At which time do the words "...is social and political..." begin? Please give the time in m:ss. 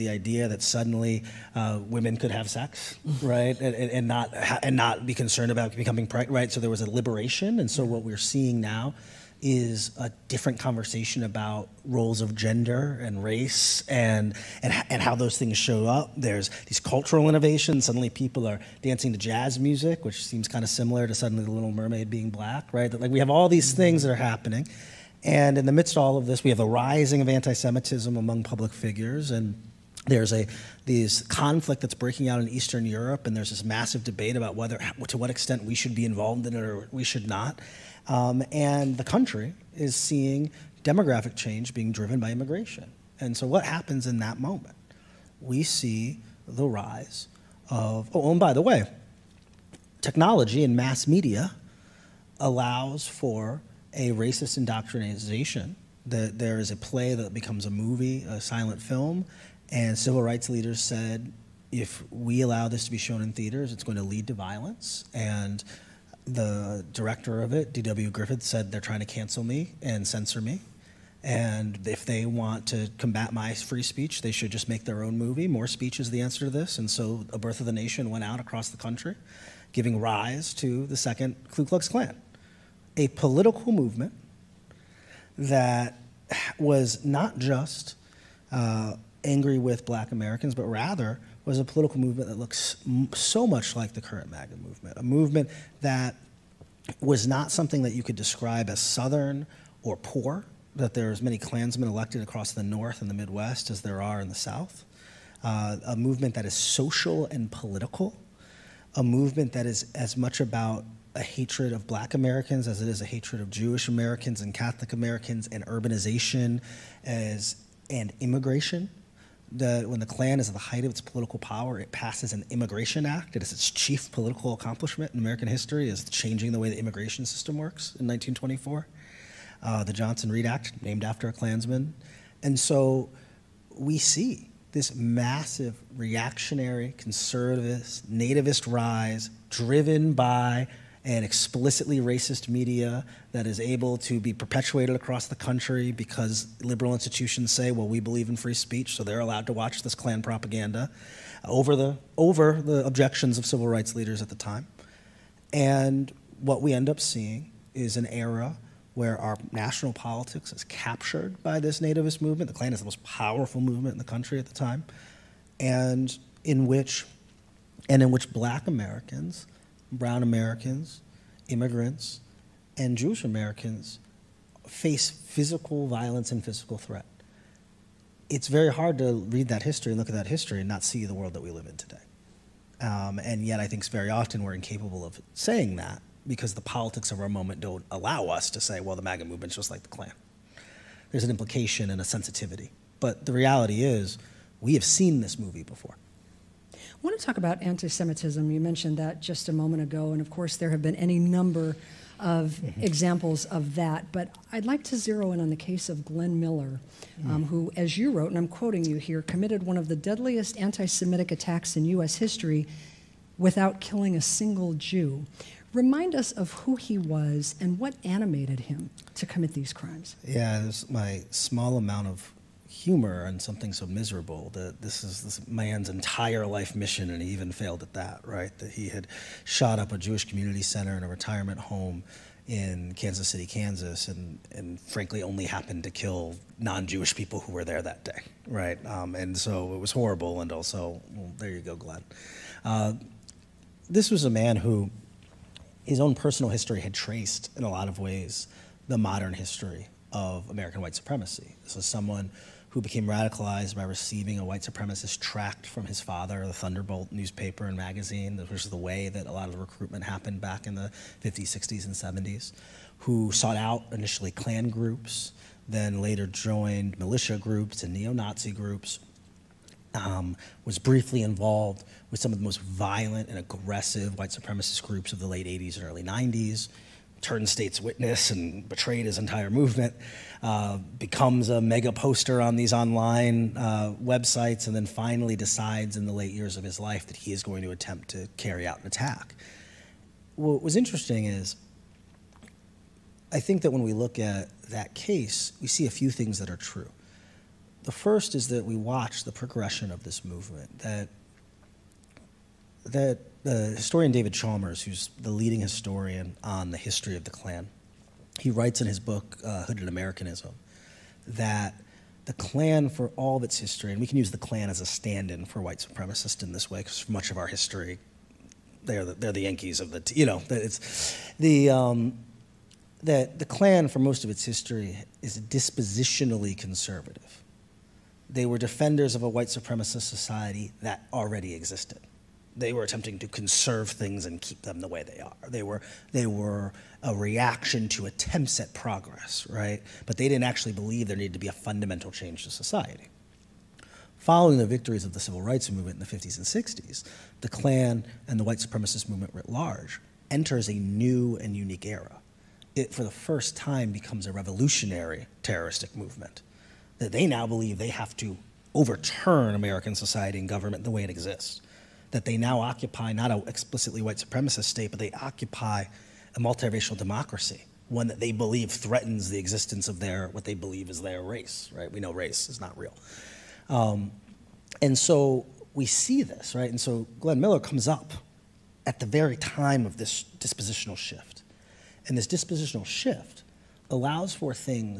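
1:46.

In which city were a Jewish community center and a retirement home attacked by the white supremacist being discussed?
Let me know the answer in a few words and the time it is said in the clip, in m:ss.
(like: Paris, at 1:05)
Kansas City, at 3:52.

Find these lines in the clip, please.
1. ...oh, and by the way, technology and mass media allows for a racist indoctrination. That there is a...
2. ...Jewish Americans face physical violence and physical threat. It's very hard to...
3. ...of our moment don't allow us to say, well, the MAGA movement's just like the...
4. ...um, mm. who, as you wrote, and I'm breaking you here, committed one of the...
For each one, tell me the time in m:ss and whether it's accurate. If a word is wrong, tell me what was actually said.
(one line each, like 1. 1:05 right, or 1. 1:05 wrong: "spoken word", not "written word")
1. 0:48 right
2. 2:52 right
3. 3:07 right
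4. 3:27 wrong: "quoting", not "breaking".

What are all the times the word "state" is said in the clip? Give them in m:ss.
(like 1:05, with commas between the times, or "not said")
4:37, 6:04.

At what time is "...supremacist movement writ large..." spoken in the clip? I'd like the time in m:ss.
5:48.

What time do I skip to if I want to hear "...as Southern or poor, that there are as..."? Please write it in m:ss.
1:38.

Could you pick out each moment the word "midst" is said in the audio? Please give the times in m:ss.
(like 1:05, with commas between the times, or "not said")
0:25.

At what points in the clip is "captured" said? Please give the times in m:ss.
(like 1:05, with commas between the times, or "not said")
2:40.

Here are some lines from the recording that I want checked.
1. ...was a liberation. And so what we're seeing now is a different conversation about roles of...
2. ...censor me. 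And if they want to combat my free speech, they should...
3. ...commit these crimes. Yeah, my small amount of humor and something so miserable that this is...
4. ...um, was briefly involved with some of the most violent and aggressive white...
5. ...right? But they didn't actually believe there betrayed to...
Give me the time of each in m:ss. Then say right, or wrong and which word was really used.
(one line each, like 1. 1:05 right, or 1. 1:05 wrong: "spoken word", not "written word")
1. 0:06 right
2. 1:10 right
3. 3:39 right
4. 4:29 right
5. 5:39 wrong: "needed", not "betrayed".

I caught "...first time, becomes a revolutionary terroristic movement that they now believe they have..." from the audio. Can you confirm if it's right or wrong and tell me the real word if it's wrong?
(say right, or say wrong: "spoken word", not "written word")
right.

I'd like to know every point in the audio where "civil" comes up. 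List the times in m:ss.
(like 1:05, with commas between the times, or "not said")
0:59, 2:33, 5:45.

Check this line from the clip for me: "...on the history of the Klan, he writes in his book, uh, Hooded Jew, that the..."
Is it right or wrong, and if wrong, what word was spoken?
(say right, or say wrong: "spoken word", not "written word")
wrong: "Americanism", not "Jew".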